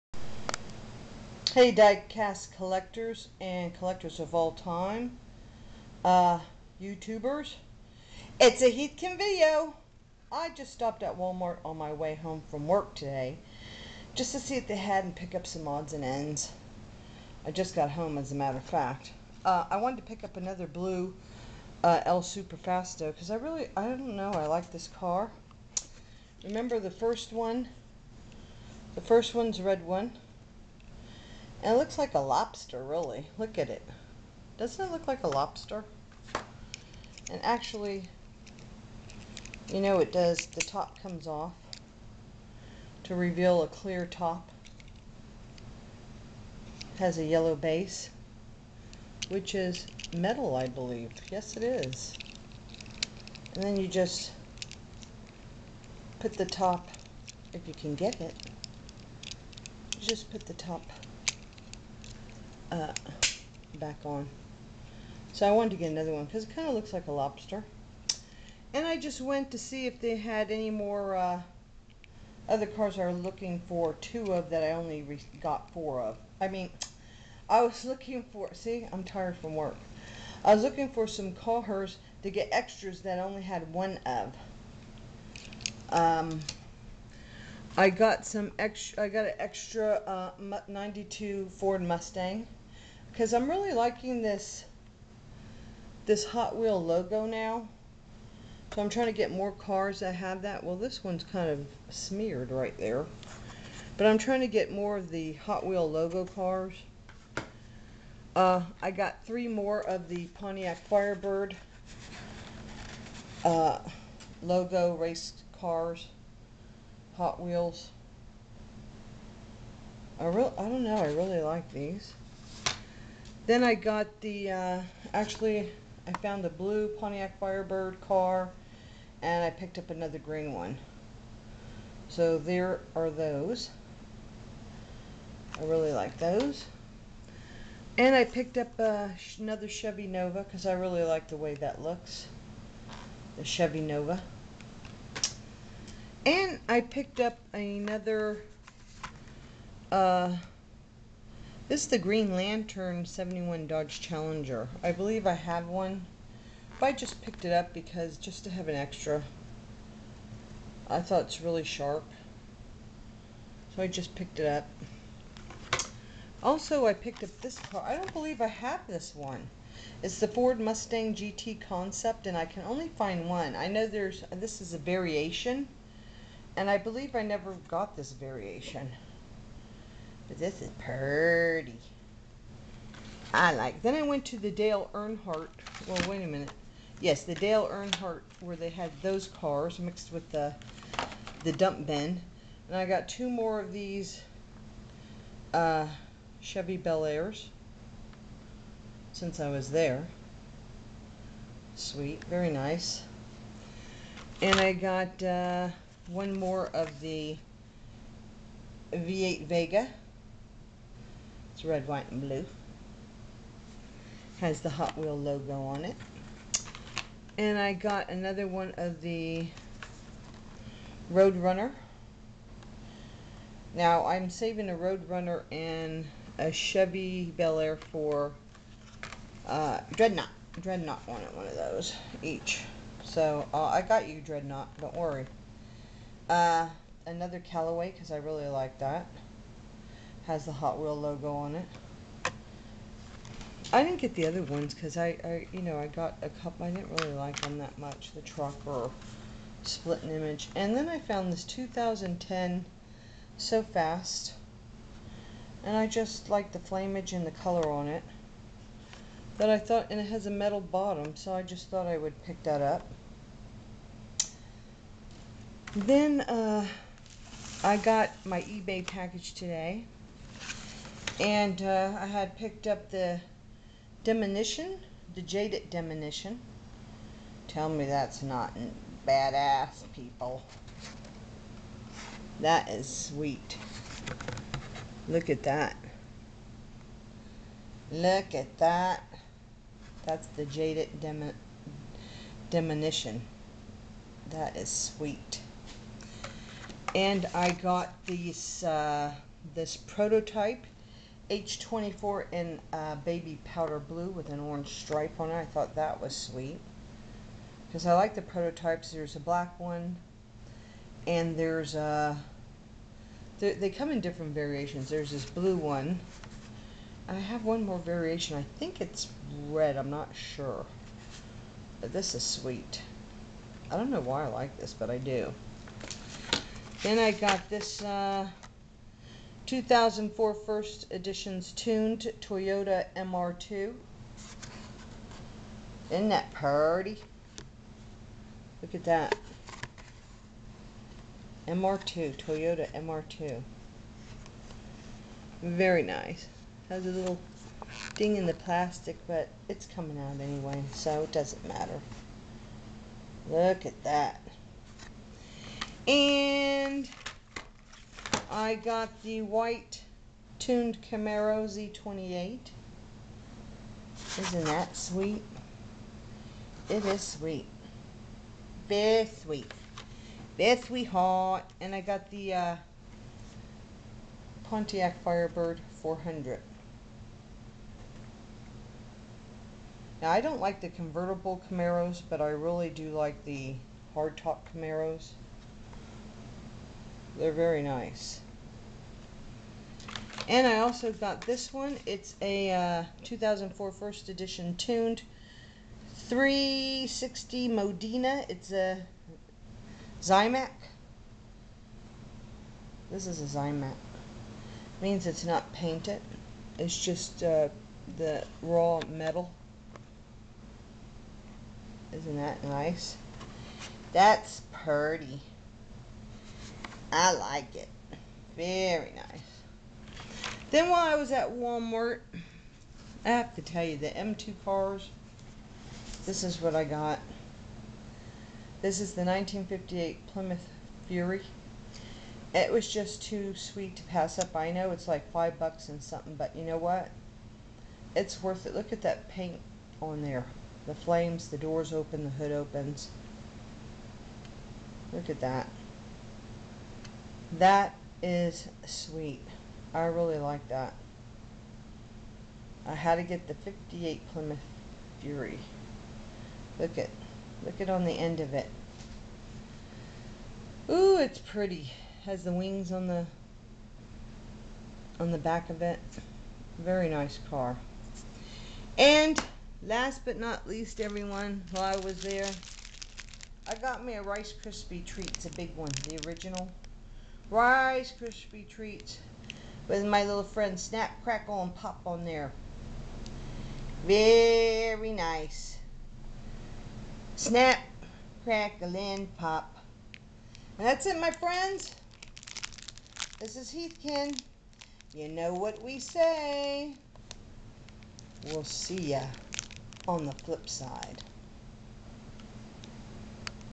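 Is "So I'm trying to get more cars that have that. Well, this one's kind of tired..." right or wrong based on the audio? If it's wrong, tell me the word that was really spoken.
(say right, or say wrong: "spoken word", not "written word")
wrong: "smeared", not "tired".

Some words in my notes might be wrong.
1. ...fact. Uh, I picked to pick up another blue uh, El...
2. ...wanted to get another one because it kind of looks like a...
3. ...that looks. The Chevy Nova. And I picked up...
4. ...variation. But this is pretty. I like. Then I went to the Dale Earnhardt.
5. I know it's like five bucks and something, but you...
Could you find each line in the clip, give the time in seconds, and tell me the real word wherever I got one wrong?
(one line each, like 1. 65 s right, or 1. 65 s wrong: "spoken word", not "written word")
1. 18 s wrong: "wanted", not "picked"
2. 65 s right
3. 141 s right
4. 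178 s right
5. 434 s right.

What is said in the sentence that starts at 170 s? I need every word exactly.
It's the Ford Mustang GT Concept, and I can only find one.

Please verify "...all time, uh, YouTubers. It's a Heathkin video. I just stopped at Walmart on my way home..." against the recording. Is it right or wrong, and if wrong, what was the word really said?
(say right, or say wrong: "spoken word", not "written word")
right.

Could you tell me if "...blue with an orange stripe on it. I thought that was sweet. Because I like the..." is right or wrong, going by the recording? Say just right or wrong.
right.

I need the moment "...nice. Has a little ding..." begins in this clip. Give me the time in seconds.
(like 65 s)
345 s.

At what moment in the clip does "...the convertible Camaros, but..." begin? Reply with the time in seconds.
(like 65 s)
380 s.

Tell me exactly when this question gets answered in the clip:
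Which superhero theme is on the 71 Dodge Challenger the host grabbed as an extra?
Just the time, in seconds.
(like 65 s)
151 s.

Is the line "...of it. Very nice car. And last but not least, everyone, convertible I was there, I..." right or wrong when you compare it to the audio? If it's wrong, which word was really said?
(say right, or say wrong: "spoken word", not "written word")
wrong: "while", not "convertible".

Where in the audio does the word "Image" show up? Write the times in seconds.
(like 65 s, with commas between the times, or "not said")
250 s.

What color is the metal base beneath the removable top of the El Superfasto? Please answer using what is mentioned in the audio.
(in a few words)
Yellow.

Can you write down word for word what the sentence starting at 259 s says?
That I thought, and it has a metal bottom, so I just thought I would pick that up.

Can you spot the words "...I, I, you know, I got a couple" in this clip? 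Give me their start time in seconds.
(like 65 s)
244 s.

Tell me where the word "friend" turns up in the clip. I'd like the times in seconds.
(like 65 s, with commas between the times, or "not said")
480 s, 491 s.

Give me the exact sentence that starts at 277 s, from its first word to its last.
Tell me that's not badass, people.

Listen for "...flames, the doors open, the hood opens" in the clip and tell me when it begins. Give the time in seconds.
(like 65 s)
440 s.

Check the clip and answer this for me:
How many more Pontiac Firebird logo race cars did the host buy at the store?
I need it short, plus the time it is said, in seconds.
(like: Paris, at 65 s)
3, at 109 s.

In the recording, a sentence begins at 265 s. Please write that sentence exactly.
Then uh, I got my eBay package today.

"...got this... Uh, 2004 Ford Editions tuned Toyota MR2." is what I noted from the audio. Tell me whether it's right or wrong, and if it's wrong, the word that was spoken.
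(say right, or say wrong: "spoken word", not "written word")
wrong: "First", not "Ford".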